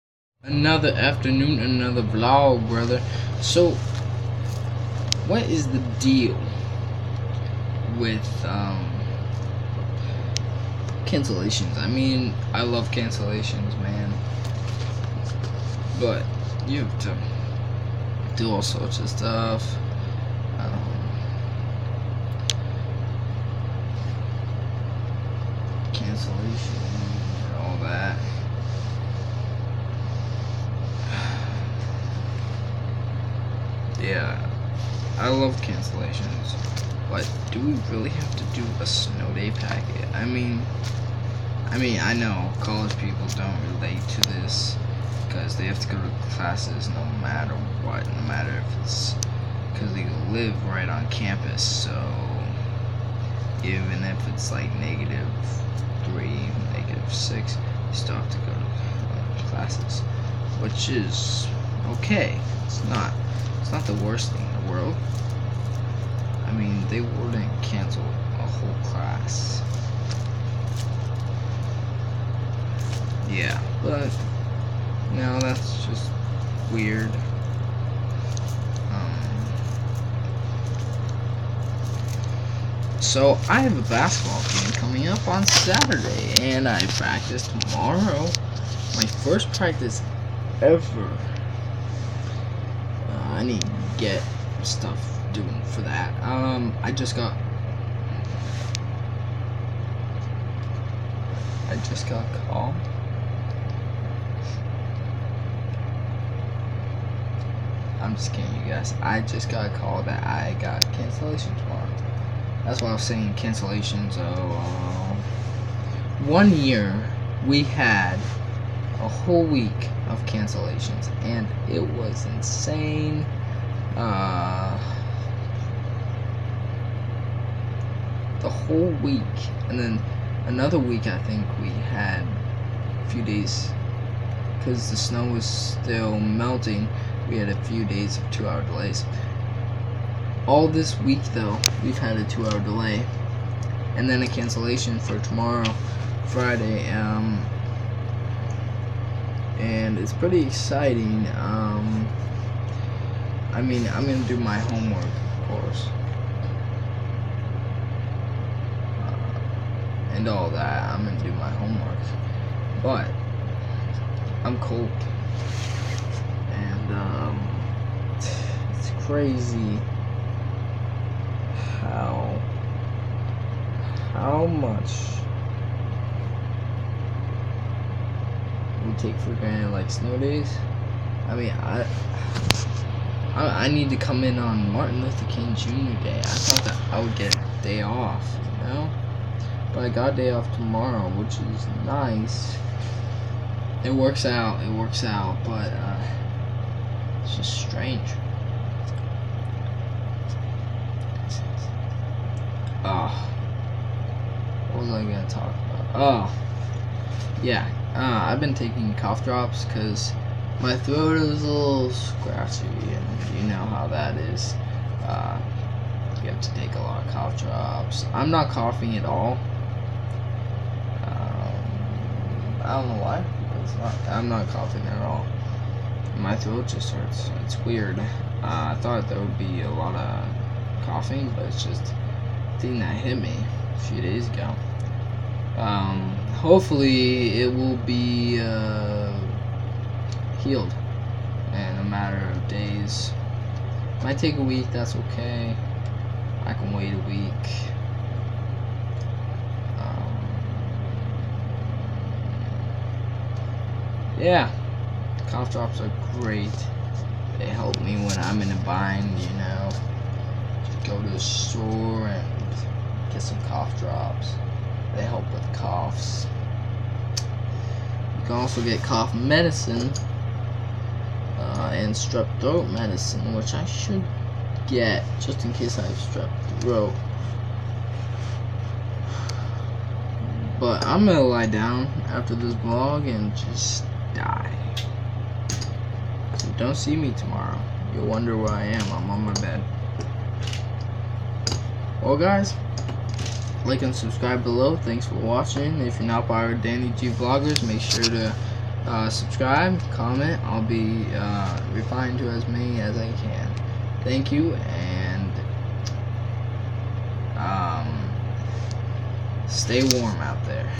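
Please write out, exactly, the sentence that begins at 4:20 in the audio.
Just go to the store and get some cough drops.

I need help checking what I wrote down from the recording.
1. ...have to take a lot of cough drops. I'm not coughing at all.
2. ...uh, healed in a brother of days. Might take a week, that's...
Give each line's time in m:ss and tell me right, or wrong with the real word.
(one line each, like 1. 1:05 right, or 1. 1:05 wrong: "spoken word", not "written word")
1. 3:36 right
2. 3:58 wrong: "matter", not "brother".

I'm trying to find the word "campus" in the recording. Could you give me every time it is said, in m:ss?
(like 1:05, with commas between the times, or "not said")
0:51.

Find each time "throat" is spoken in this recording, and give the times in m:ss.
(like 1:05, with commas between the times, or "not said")
3:30, 3:46, 4:32, 4:36.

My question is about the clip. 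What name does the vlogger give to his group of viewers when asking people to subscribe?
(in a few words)
Danny G Vloggers.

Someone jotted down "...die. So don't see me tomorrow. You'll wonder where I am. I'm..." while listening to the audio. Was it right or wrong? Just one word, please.
right.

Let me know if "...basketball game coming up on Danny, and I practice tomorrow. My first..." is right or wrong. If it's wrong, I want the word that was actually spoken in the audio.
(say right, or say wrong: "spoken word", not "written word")
wrong: "Saturday", not "Danny".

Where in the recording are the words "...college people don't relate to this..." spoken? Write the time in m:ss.
0:42.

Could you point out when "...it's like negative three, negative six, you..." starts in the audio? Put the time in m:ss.
0:54.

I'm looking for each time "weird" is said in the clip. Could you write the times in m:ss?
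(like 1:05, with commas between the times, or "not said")
1:16, 3:47.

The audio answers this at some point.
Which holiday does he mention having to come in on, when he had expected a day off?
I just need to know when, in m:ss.
3:04.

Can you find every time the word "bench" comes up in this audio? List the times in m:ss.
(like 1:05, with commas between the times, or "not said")
not said.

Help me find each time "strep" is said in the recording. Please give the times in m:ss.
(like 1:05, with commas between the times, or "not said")
4:31, 4:35.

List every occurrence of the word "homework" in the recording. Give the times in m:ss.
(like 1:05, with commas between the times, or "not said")
2:34, 2:41.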